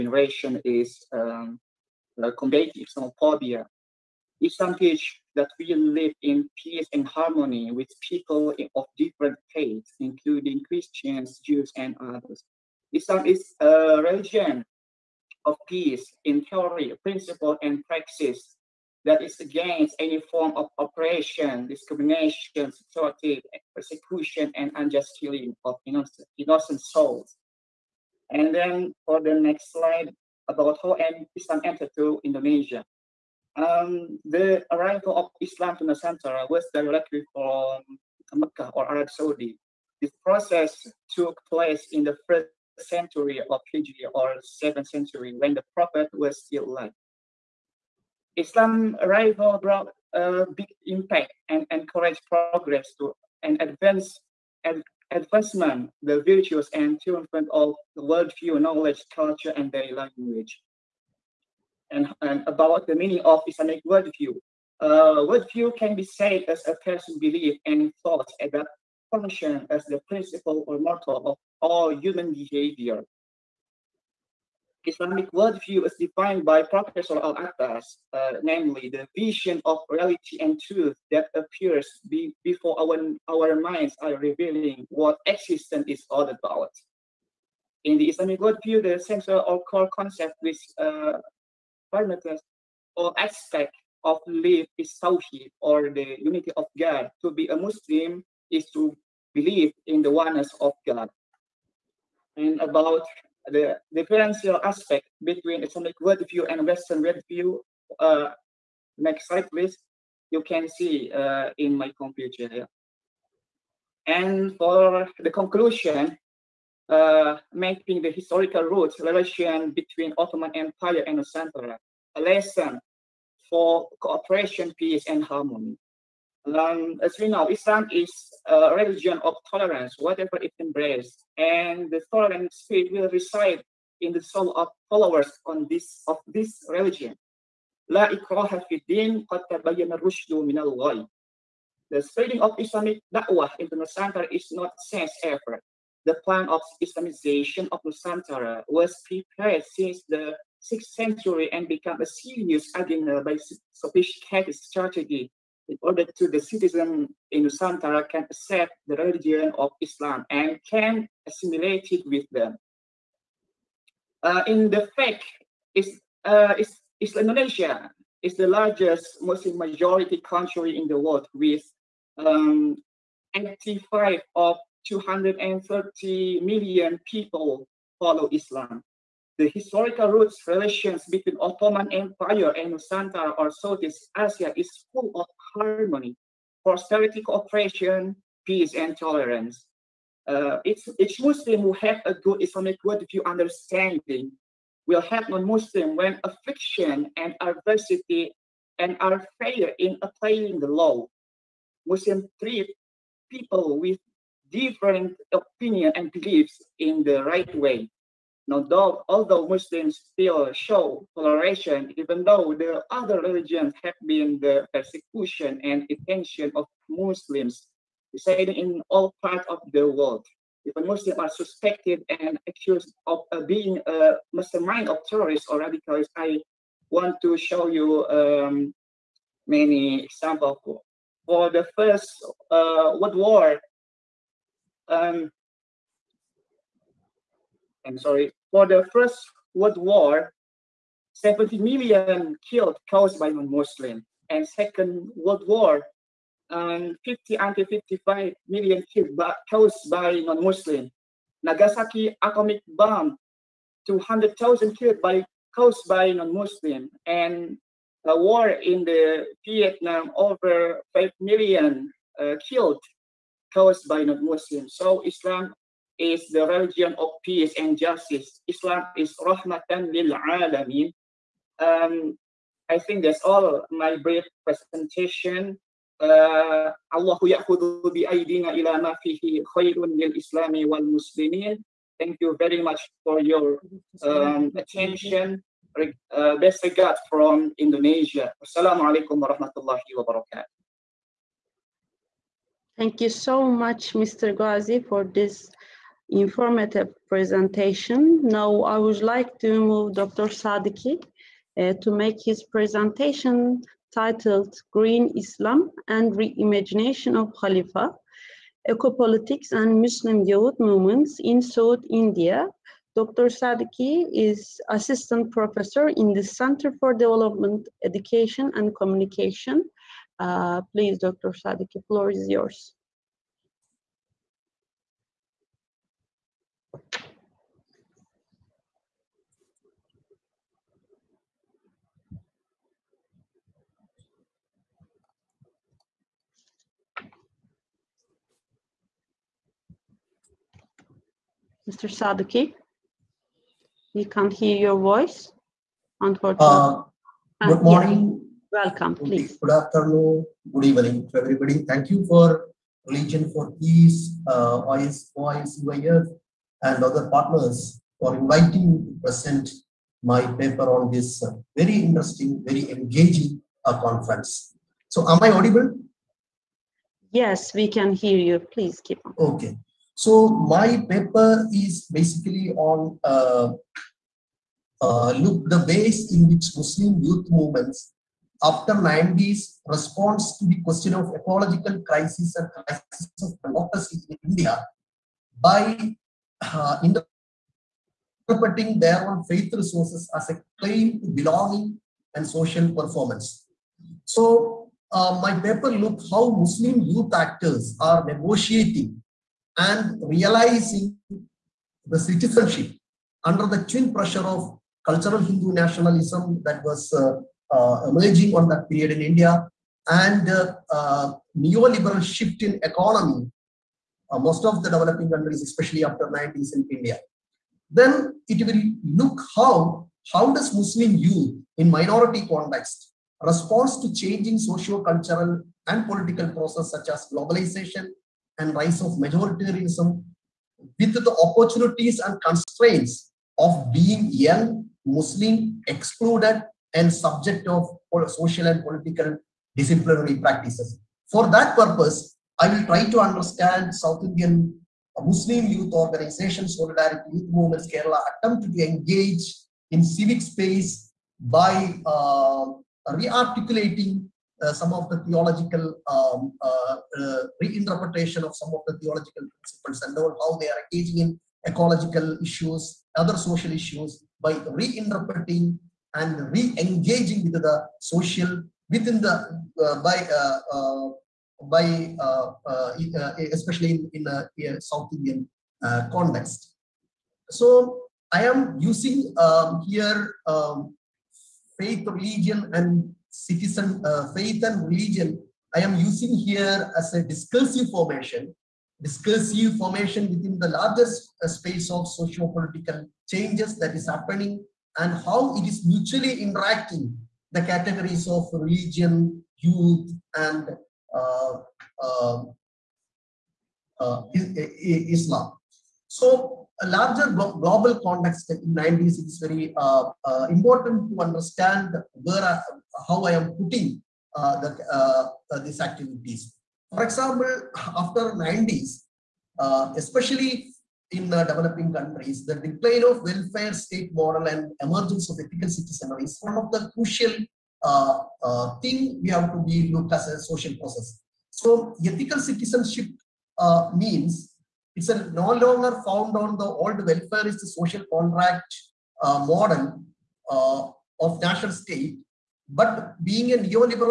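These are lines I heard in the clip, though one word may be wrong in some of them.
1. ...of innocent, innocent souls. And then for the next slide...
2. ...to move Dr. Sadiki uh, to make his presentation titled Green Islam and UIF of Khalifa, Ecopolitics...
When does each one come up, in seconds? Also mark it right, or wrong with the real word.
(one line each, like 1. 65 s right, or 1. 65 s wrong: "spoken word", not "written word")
1. 25 s right
2. 299 s wrong: "Reimagination", not "UIF".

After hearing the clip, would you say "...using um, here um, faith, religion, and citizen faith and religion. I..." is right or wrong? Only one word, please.
right.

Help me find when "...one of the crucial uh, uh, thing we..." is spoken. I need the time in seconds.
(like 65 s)
526 s.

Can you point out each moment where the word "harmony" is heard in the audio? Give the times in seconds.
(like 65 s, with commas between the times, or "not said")
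7 s, 125 s, 185 s.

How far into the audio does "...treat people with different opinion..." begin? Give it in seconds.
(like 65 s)
202 s.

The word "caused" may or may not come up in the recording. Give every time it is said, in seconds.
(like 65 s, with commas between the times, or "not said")
242 s, 249 s, 255 s, 263 s.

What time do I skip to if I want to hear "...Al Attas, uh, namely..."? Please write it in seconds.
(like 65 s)
77 s.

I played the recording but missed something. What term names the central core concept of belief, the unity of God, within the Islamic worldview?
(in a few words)
Tawheed.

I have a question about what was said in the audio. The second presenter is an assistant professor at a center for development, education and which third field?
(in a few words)
Communication.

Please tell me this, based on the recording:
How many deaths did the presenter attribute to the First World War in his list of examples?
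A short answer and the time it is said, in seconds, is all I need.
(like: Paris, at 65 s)
70 million, at 241 s.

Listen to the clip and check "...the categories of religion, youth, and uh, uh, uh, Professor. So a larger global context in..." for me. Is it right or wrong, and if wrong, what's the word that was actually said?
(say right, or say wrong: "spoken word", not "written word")
wrong: "Islam", not "Professor".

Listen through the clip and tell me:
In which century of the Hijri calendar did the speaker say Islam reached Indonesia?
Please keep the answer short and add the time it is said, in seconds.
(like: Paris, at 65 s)
First century, at 42 s.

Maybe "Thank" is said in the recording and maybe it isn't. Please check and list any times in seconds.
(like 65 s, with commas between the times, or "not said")
281 s, 292 s, 351 s.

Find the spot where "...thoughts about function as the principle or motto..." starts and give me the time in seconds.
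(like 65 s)
68 s.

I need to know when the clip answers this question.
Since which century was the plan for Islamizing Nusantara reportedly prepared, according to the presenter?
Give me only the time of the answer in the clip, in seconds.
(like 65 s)
150 s.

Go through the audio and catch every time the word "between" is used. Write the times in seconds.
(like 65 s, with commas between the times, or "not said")
105 s, 119 s, 181 s.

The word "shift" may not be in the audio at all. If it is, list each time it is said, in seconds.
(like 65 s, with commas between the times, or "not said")
412 s.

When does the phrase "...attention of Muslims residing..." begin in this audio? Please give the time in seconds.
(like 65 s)
215 s.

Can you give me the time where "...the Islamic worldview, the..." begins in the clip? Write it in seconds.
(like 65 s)
87 s.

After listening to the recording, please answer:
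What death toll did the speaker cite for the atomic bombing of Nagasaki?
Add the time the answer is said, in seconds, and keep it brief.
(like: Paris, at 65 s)
200,000, at 253 s.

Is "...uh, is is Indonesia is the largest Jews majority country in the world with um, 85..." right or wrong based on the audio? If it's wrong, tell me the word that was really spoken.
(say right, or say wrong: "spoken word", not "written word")
wrong: "Muslim", not "Jews".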